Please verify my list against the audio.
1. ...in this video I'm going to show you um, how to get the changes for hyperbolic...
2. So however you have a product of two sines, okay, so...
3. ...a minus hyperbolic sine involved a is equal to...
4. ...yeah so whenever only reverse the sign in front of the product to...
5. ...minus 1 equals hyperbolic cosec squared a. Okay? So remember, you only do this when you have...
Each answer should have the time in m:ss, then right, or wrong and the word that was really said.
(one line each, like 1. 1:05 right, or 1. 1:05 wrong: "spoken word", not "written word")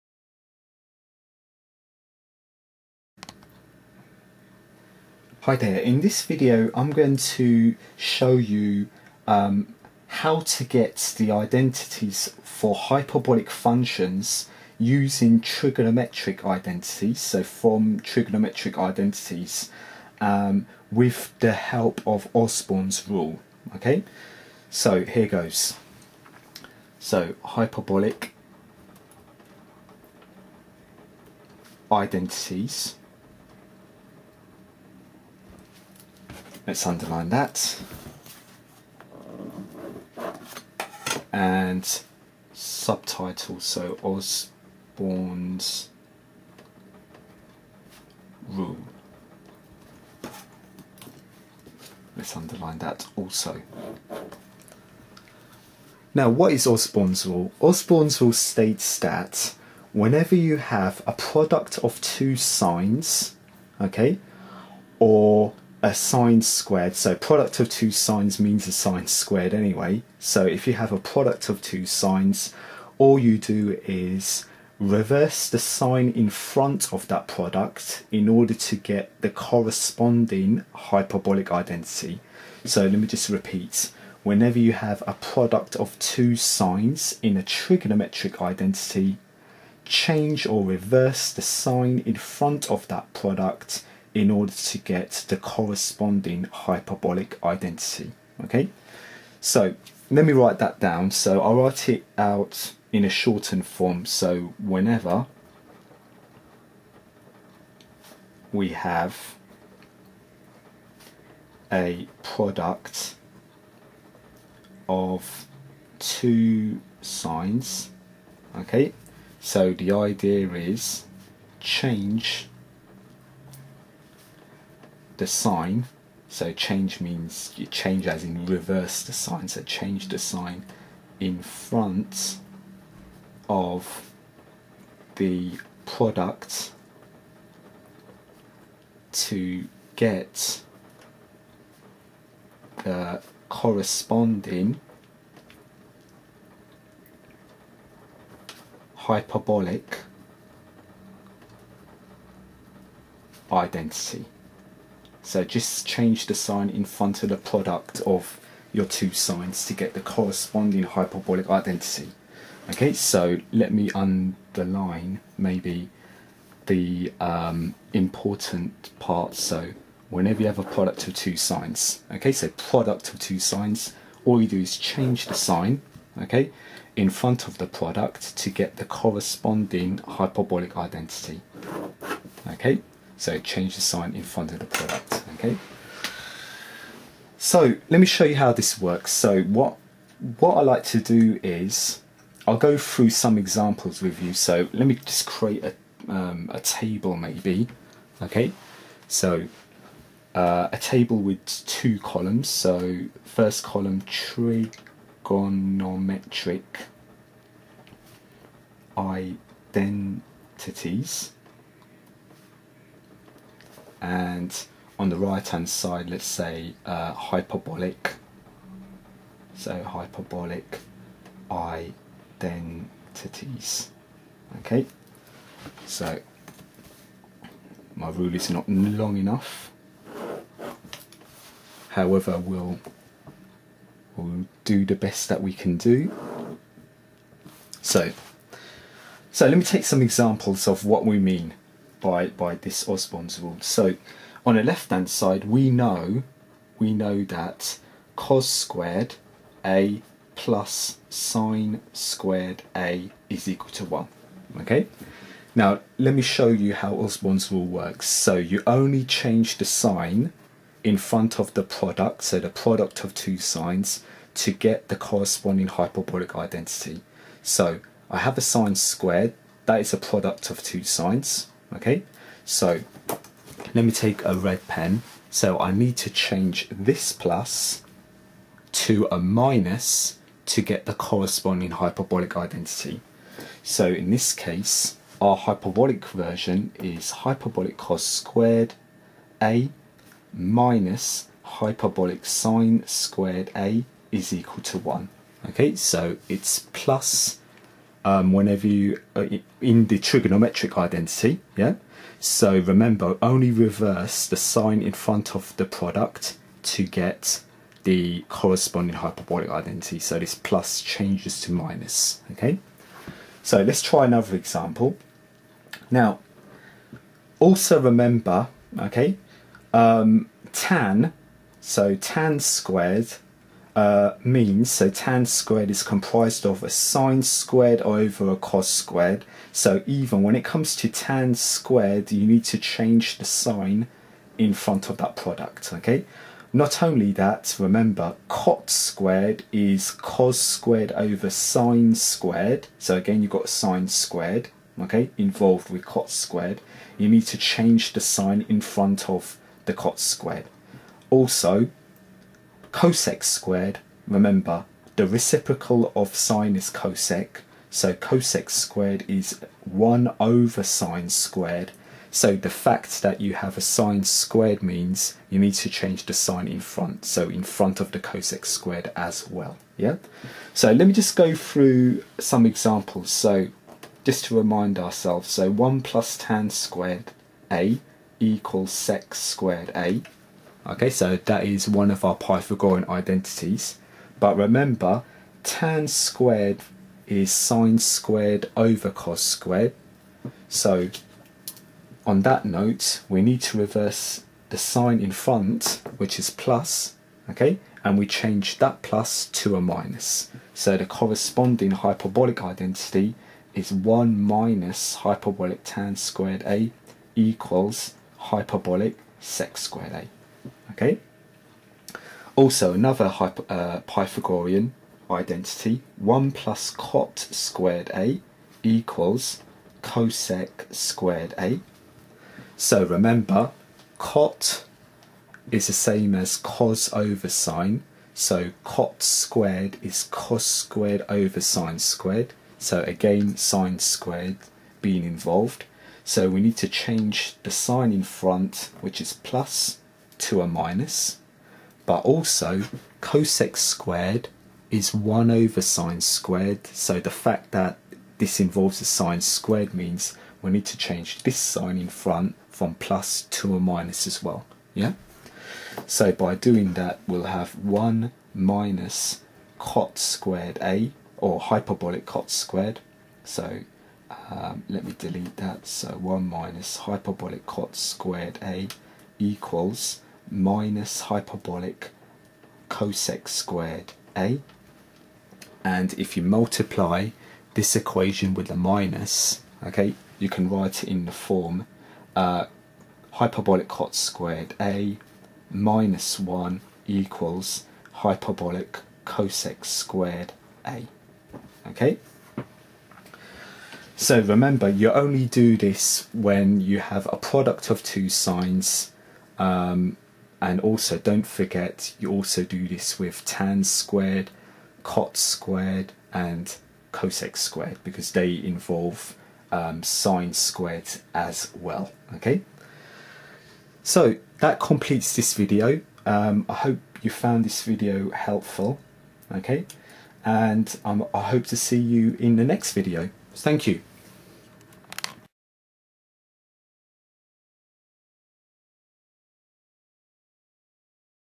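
1. 0:05 wrong: "identities", not "changes"
2. 2:49 wrong: "whenever", not "however"
3. 4:49 wrong: "squared", not "involved"
4. 5:01 wrong: "remember", not "whenever"
5. 8:05 right.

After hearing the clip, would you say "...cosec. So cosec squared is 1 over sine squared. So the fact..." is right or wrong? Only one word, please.
right.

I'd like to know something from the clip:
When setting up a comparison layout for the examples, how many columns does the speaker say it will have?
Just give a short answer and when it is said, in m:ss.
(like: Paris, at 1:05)
2, at 3:21.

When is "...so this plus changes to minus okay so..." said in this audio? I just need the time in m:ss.
5:09.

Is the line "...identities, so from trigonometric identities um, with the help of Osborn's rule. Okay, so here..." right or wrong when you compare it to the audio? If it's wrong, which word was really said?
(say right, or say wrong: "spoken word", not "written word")
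right.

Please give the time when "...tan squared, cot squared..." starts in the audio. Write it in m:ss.
8:23.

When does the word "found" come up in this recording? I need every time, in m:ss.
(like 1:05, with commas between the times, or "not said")
8:37.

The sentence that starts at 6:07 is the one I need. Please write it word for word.
So in front of the cosec squared as well.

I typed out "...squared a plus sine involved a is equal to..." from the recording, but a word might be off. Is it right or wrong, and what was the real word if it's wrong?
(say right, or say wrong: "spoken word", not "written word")
wrong: "squared", not "involved".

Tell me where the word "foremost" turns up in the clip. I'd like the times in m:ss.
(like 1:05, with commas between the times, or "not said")
not said.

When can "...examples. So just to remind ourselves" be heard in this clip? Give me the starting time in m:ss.
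6:12.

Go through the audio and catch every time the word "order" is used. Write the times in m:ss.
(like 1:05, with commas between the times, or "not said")
1:18, 1:34.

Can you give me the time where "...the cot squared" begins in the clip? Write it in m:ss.
5:49.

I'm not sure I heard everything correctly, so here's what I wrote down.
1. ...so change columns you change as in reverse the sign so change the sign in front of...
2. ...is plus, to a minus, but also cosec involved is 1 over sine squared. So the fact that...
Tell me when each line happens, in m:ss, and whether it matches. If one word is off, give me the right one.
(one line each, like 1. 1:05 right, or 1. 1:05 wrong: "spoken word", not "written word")
1. 2:06 wrong: "means", not "columns"
2. 7:18 wrong: "squared", not "involved".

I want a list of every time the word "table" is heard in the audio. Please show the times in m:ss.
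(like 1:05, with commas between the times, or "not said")
3:16, 3:20.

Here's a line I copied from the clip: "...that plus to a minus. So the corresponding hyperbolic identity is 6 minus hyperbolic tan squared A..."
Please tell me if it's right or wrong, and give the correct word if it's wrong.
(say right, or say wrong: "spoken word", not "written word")
wrong: "1", not "6".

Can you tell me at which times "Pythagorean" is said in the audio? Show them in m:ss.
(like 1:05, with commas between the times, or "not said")
6:22, 6:53.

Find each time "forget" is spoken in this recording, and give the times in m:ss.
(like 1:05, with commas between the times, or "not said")
8:21.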